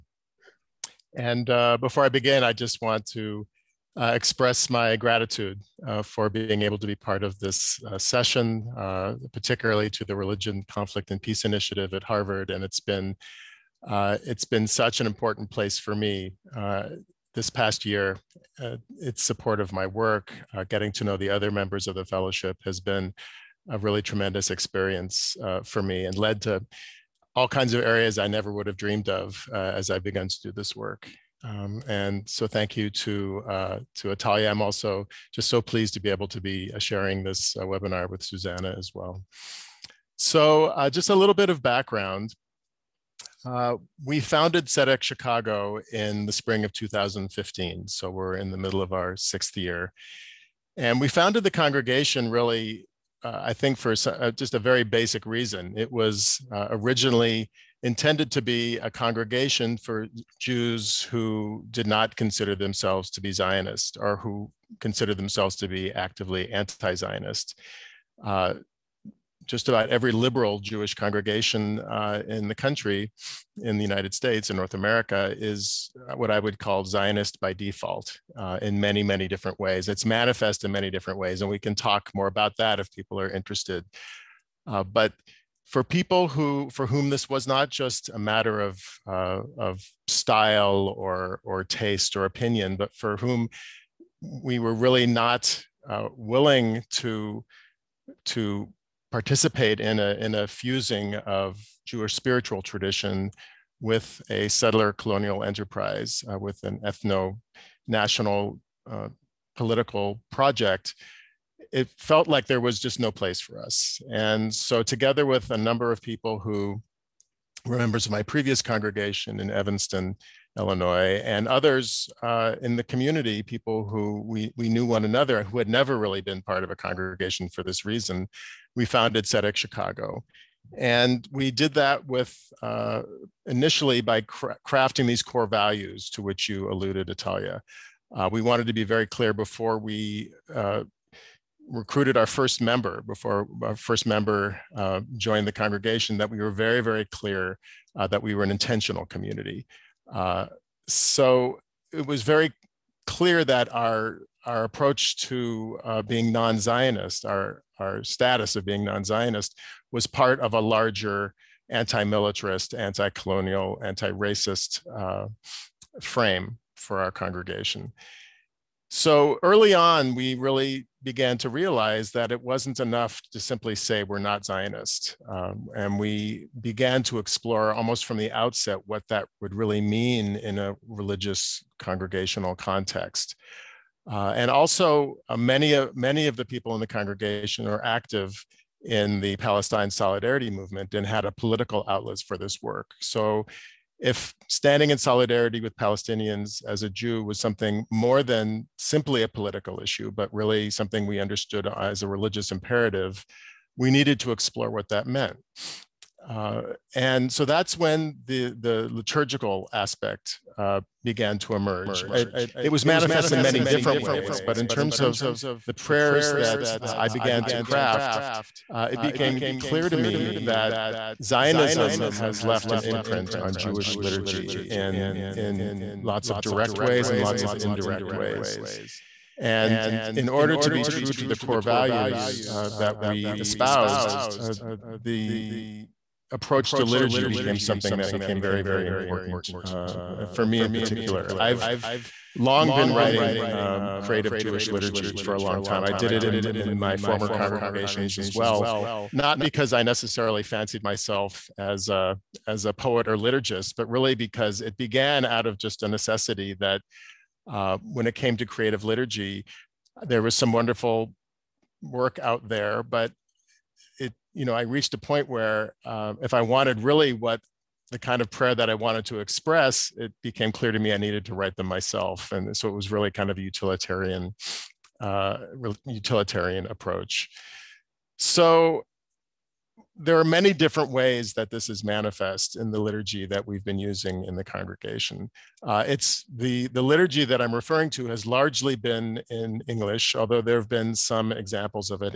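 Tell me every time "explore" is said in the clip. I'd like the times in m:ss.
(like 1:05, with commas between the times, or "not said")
2:57, 3:24.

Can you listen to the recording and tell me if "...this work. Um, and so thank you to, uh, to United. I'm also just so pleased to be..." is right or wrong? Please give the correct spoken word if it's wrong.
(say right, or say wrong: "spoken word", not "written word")
wrong: "Atalia", not "United".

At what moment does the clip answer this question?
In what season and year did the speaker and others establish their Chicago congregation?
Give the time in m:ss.
0:46.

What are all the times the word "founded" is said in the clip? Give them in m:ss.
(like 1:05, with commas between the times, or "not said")
0:44, 0:51, 2:08.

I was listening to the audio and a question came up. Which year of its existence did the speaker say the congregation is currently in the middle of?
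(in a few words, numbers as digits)
Sixth.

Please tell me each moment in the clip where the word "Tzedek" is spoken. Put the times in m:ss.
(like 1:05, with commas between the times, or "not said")
0:44, 2:09.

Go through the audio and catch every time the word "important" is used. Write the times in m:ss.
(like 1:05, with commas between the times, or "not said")
0:15, 3:58.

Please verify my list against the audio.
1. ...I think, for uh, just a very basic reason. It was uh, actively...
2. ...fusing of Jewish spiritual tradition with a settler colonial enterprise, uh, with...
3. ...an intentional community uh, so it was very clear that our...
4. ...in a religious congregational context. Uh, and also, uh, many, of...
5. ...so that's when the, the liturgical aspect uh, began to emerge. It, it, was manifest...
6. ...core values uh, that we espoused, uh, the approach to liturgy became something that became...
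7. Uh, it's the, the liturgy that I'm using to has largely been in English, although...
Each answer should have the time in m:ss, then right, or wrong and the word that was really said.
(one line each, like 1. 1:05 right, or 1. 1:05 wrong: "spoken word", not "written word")
1. 0:53 wrong: "originally", not "actively"
2. 1:40 right
3. 2:28 right
4. 3:00 right
5. 3:27 right
6. 3:51 right
7. 4:45 wrong: "referring", not "using".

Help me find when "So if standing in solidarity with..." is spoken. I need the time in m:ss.
3:12.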